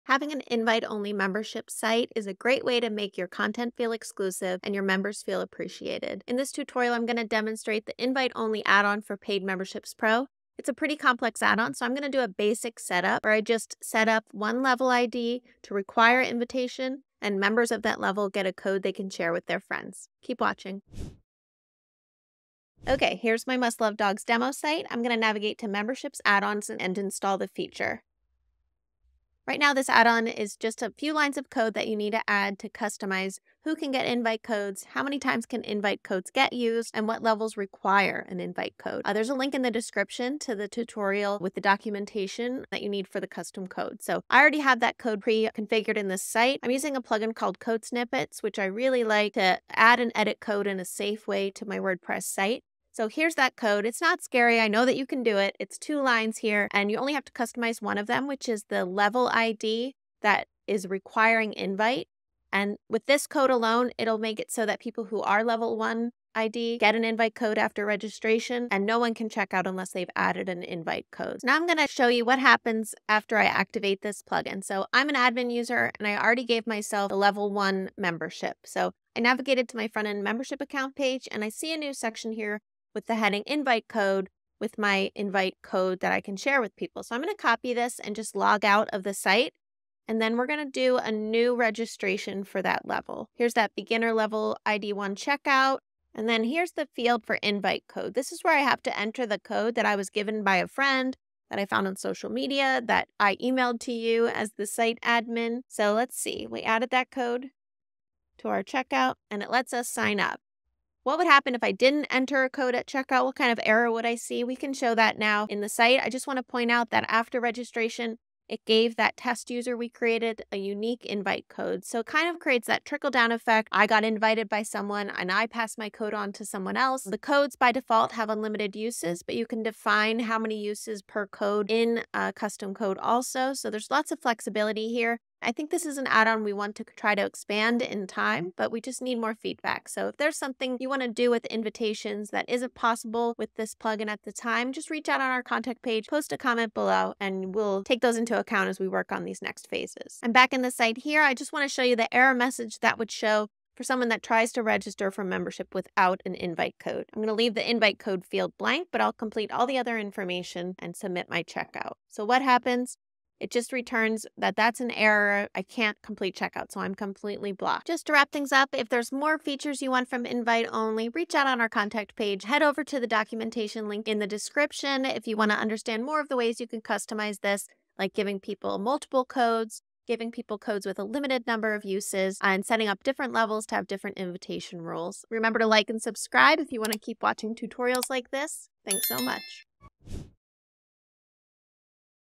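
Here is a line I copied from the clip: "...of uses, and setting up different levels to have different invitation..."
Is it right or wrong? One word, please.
right.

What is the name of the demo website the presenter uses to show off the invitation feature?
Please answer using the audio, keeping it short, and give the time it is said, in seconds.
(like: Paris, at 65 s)
Must Love Dogs, at 23 s.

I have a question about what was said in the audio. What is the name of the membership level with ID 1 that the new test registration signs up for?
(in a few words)
beginner.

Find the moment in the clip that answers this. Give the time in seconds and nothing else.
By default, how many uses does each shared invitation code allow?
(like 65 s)
128 s.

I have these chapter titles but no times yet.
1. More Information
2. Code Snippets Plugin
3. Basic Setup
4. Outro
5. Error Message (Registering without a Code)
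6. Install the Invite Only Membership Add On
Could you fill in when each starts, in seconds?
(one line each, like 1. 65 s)
1. 116 s
2. 47 s
3. 71 s
4. 167 s
5. 150 s
6. 23 s.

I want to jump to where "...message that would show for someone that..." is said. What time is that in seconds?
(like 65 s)
152 s.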